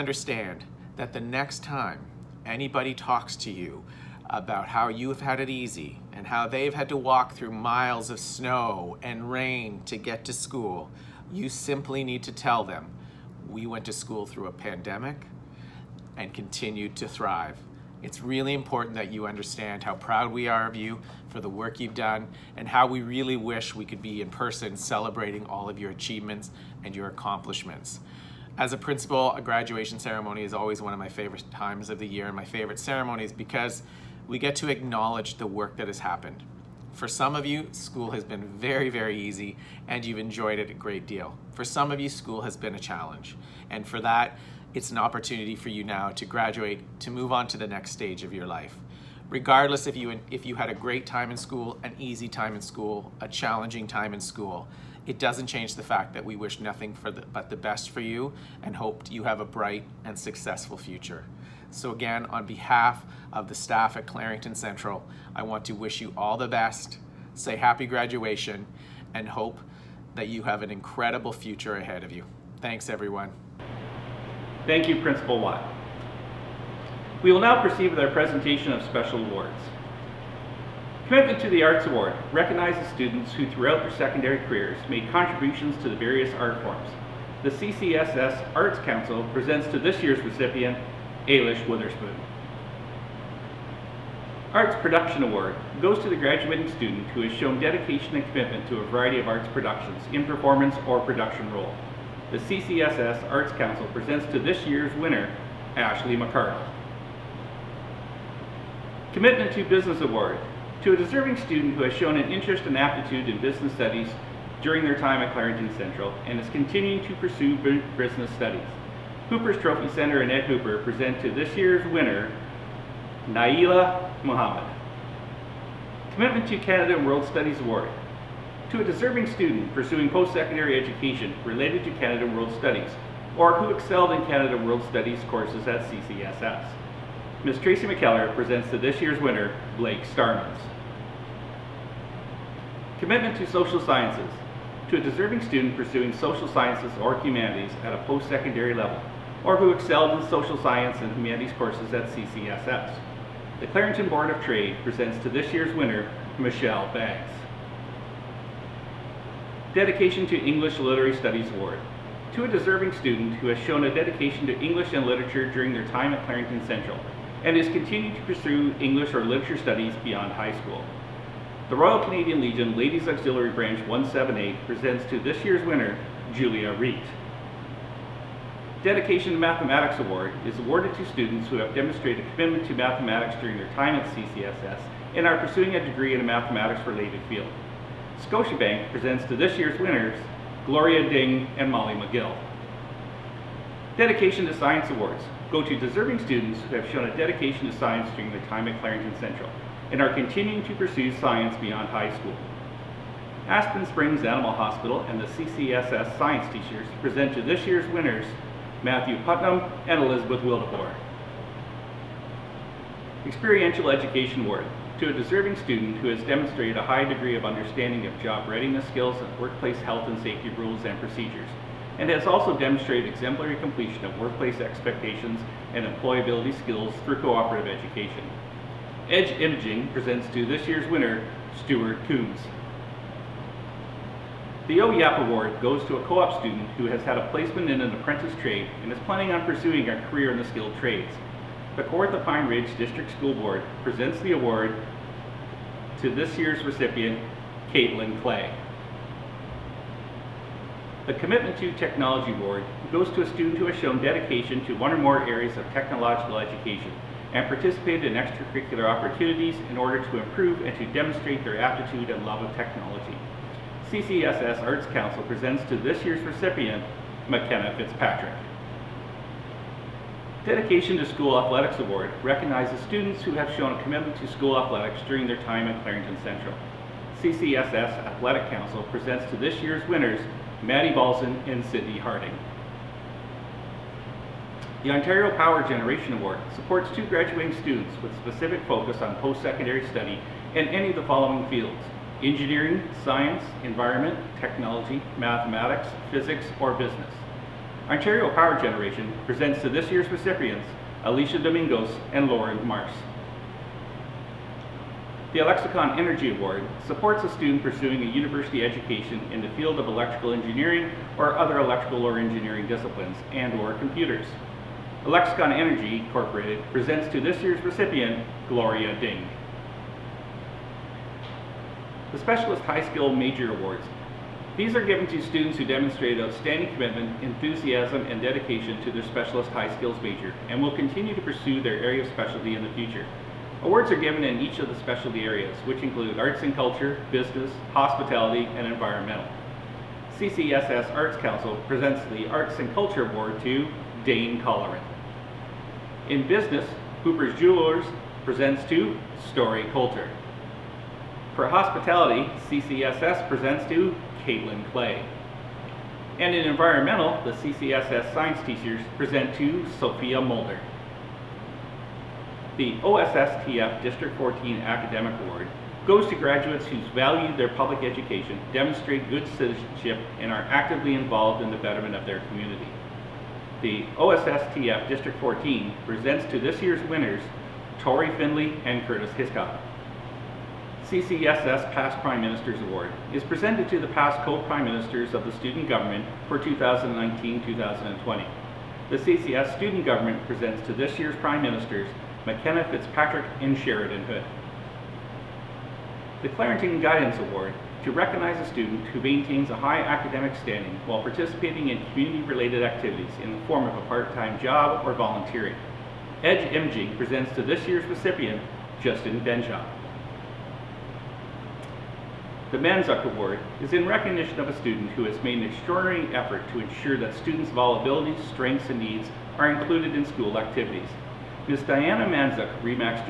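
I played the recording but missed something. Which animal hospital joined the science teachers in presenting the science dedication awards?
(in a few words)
Aspen Springs Animal Hospital.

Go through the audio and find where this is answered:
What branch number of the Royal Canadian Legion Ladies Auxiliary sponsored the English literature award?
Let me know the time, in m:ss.
2:53.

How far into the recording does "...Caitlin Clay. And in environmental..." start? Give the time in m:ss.
5:54.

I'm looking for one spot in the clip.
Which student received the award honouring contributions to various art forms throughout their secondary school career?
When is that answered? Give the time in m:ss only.
1:31.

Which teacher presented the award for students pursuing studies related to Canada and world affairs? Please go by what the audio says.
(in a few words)
Tracy McKellar.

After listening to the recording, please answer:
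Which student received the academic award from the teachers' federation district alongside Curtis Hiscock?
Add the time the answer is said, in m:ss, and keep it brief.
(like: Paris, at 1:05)
Tori Finley, at 6:17.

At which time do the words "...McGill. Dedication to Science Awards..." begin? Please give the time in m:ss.
3:11.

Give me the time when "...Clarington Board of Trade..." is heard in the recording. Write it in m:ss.
2:33.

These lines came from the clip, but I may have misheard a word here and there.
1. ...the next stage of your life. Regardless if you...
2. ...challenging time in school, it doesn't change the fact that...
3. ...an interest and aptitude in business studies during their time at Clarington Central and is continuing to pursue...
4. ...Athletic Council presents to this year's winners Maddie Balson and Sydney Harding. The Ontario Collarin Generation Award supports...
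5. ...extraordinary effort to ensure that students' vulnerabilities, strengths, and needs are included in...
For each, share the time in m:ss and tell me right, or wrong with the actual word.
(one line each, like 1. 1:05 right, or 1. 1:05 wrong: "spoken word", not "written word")
1. 0:47 right
2. 0:53 right
3. 1:52 right
4. 4:38 wrong: "Power", not "Collarin"
5. 6:55 right.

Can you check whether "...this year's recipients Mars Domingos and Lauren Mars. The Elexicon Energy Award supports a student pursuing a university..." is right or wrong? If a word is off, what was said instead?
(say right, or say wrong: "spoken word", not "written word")
wrong: "Alicia", not "Mars".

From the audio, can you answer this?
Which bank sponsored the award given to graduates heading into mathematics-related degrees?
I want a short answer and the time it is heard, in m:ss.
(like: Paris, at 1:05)
Scotiabank, at 3:08.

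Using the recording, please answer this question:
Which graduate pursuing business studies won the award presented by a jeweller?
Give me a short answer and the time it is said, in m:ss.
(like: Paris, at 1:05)
Naila Muhammad, at 2:03.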